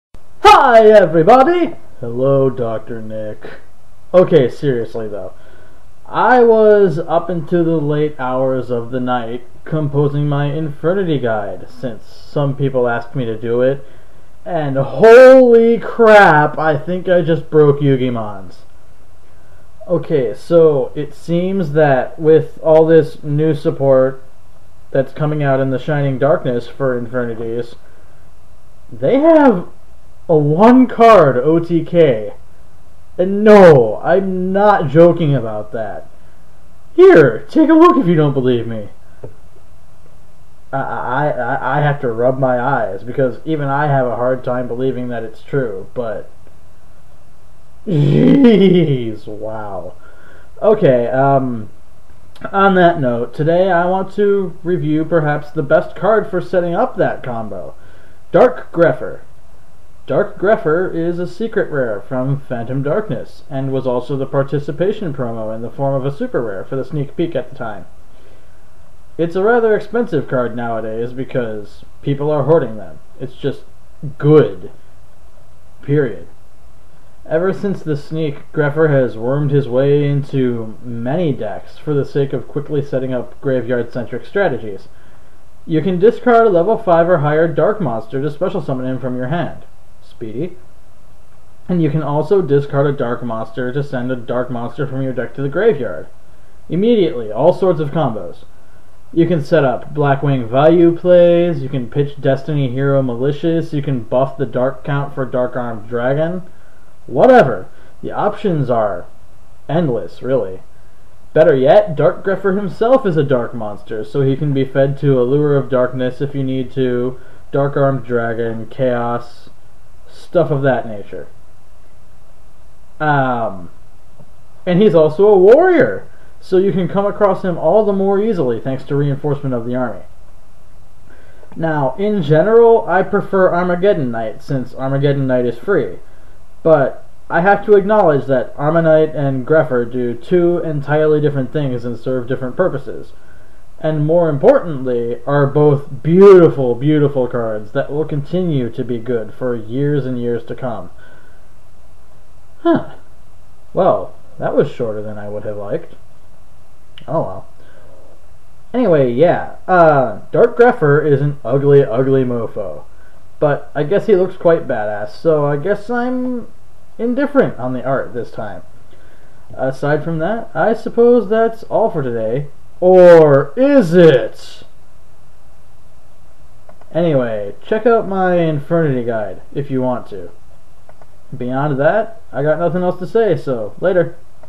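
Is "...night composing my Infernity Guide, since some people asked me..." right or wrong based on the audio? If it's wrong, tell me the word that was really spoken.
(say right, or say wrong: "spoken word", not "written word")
right.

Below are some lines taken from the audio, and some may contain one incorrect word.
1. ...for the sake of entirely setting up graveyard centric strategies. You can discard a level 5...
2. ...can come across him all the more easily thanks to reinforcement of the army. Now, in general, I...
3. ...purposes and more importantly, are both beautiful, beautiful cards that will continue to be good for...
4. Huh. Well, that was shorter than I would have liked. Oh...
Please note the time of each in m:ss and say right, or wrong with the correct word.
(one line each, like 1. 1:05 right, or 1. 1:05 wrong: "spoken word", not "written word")
1. 1:21 wrong: "quickly", not "entirely"
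2. 2:06 right
3. 2:22 right
4. 2:32 right.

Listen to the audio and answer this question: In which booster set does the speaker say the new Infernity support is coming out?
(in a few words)
Shining Darkness.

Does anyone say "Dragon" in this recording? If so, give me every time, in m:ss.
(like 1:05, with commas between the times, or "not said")
1:45, 1:58.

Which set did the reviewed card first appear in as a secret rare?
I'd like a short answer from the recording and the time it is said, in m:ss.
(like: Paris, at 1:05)
Phantom Darkness, at 1:02.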